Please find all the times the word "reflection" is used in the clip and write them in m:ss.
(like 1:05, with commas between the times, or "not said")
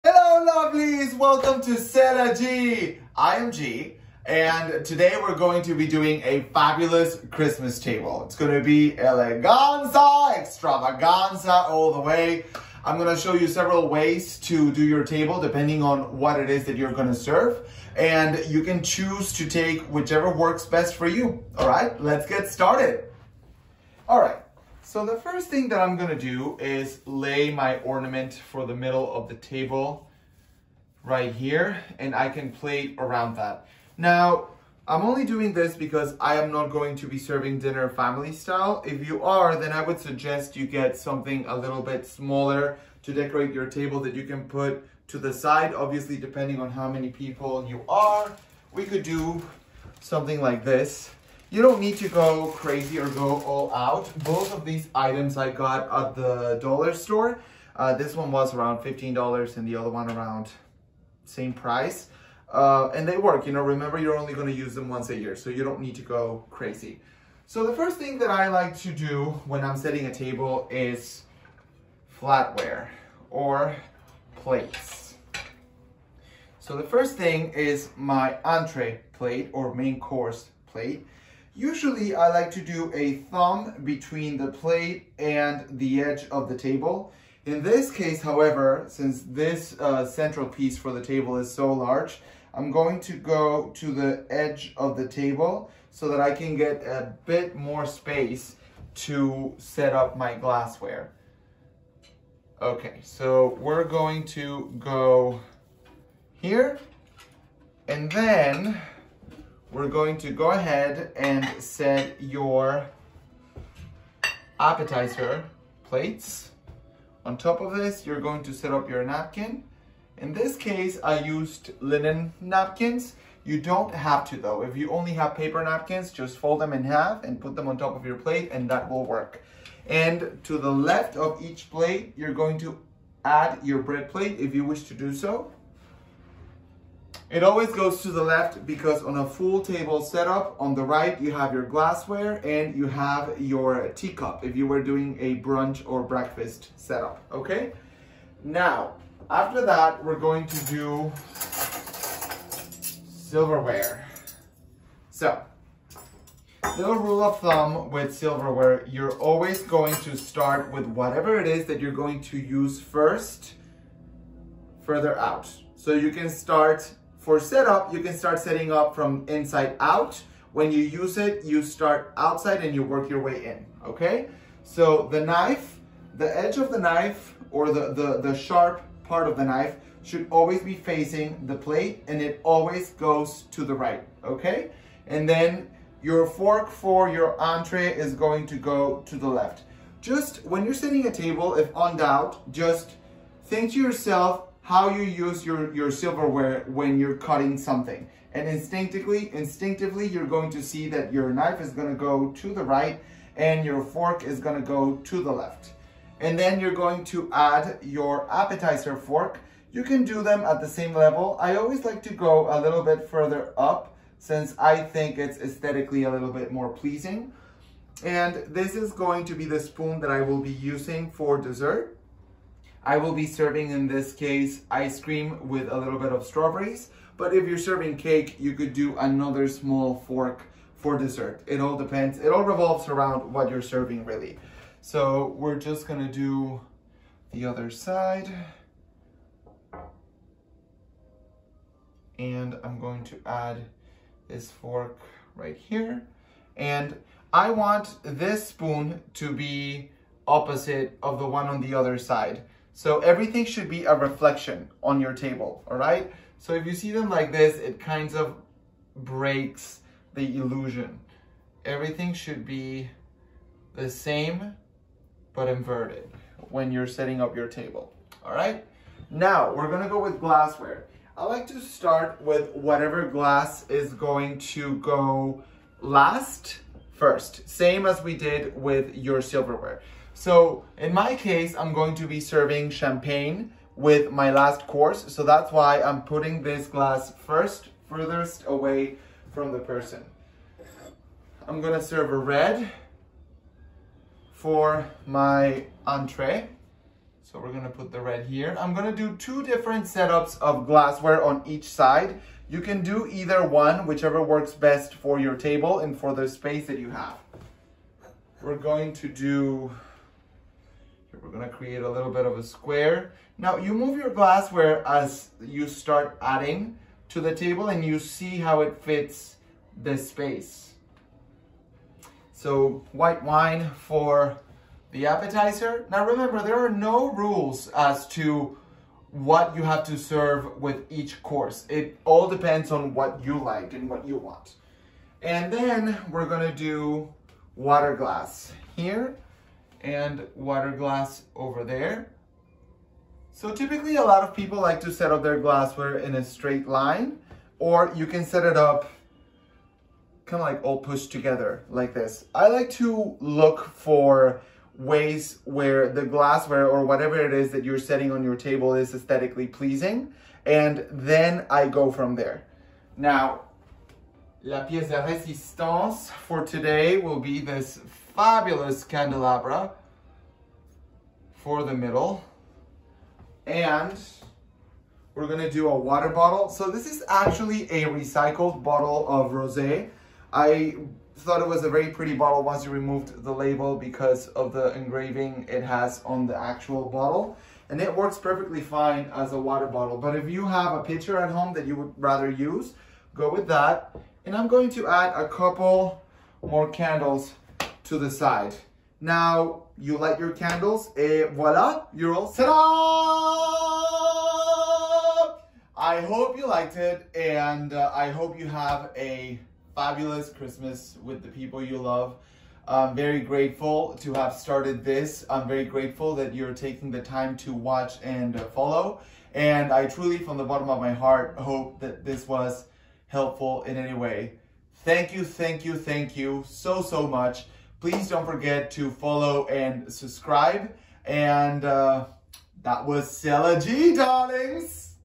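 4:13.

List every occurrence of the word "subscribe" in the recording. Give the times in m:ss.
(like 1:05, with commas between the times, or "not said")
7:09.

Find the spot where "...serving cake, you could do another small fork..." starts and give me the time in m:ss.
3:47.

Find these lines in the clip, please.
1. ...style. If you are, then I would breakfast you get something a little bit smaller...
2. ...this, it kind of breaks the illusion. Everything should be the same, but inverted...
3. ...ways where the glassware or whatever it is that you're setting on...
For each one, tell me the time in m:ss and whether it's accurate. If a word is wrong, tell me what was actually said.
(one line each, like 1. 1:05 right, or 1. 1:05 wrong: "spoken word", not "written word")
1. 0:38 wrong: "suggest", not "breakfast"
2. 4:17 right
3. 5:54 right.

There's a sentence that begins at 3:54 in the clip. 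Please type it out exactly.
So we're just gonna do the other side.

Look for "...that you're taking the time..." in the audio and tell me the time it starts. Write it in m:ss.
6:56.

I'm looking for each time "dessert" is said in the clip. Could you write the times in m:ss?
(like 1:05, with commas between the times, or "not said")
3:41, 3:50.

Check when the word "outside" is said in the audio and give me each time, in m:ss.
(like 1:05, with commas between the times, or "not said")
2:52.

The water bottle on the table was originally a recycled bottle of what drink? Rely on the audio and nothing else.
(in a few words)
Rosé.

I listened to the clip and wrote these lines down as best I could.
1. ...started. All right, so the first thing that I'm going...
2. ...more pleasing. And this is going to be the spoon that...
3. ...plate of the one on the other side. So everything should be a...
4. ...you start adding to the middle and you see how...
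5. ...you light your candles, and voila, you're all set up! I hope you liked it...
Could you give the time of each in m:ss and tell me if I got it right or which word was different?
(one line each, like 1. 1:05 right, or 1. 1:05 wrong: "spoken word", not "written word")
1. 0:22 right
2. 3:36 right
3. 4:10 wrong: "opposite", not "plate"
4. 5:15 wrong: "table", not "middle"
5. 6:39 right.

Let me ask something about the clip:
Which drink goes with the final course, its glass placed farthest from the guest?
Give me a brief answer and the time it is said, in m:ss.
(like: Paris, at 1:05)
Champagne, at 4:42.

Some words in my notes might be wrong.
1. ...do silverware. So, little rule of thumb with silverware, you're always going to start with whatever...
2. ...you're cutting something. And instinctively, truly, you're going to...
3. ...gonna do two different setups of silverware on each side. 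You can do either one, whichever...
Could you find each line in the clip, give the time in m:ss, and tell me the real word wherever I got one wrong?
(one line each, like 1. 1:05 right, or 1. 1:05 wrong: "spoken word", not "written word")
1. 2:30 right
2. 3:16 wrong: "instinctively", not "truly"
3. 4:58 wrong: "glassware", not "silverware".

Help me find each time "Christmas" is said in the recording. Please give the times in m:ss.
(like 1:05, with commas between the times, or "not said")
0:07, 6:50.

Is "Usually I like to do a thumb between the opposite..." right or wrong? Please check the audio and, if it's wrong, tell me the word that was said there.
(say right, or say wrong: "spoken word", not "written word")
wrong: "plate", not "opposite".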